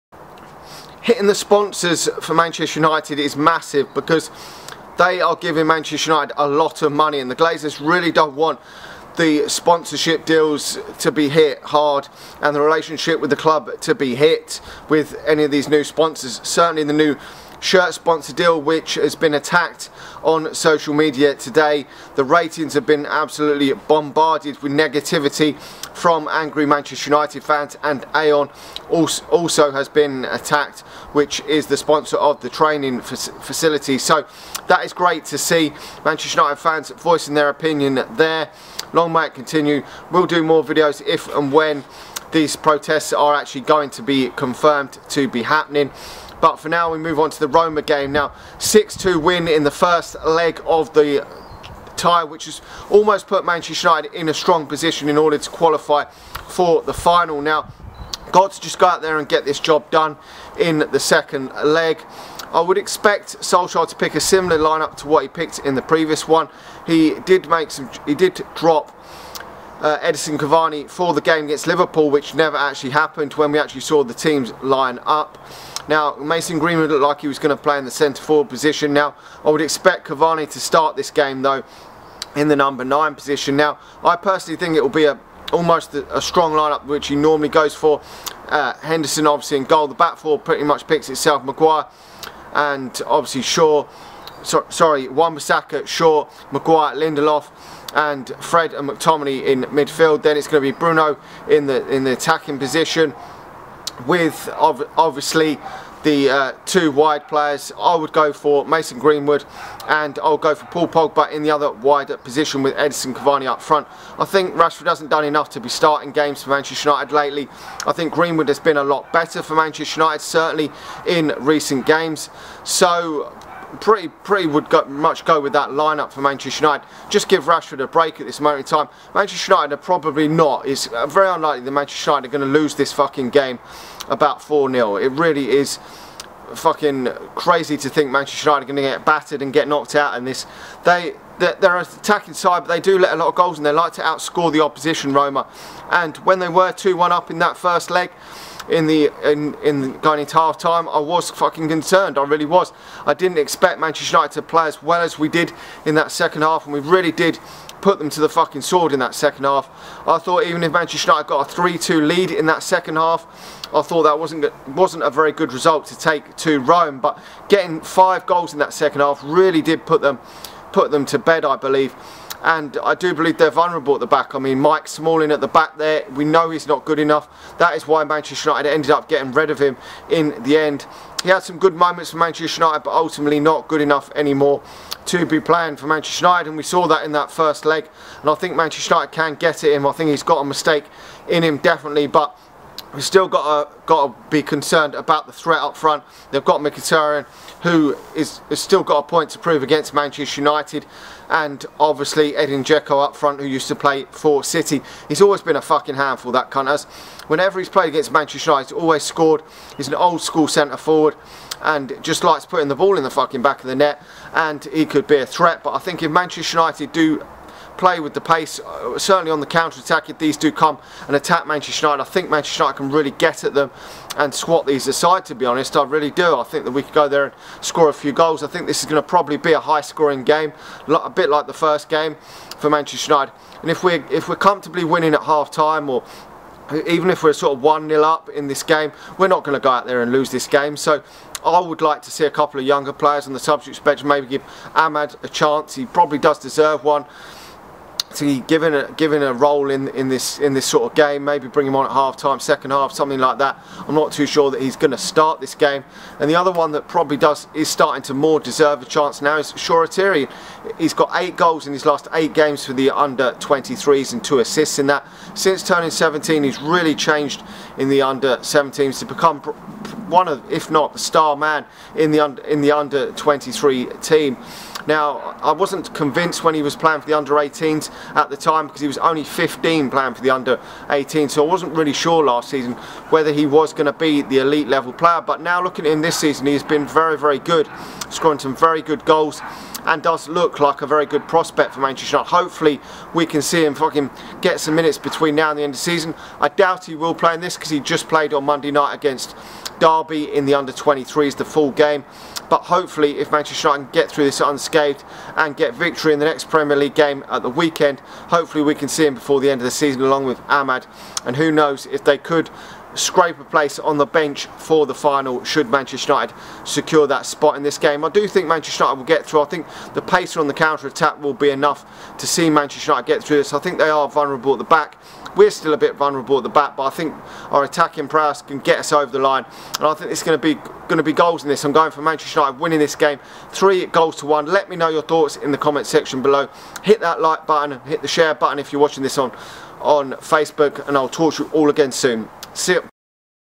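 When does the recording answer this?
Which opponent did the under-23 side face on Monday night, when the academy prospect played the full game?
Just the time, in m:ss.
4:59.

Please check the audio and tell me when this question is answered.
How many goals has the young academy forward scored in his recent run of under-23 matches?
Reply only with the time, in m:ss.
4:21.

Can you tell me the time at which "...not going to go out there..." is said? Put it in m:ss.
3:59.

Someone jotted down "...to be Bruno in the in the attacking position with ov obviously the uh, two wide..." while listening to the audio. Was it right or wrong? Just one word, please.
right.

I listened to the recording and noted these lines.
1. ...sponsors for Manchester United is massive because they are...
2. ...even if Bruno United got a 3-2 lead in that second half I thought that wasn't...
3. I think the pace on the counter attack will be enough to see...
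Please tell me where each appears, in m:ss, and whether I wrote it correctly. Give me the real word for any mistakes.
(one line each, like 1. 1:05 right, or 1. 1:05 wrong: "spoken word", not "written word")
1. 0:01 right
2. 2:40 wrong: "Manchester", not "Bruno"
3. 5:19 right.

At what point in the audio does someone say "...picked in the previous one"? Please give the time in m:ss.
1:05.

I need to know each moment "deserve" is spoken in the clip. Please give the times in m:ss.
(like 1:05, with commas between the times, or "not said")
4:06, 4:18.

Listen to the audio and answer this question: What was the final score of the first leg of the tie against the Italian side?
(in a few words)
6-2.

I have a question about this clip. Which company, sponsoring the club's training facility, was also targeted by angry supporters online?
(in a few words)
Aon.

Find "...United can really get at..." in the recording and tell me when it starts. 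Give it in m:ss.
3:42.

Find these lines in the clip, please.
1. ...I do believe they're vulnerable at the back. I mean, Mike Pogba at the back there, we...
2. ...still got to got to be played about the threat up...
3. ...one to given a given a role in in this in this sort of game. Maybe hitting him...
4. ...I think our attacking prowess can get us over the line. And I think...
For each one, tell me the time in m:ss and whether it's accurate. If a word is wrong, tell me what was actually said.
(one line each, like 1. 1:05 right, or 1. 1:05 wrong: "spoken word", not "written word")
1. 2:52 wrong: "Smalling", not "Pogba"
2. 3:13 wrong: "concerned", not "played"
3. 4:06 wrong: "bring", not "hitting"
4. 5:26 right.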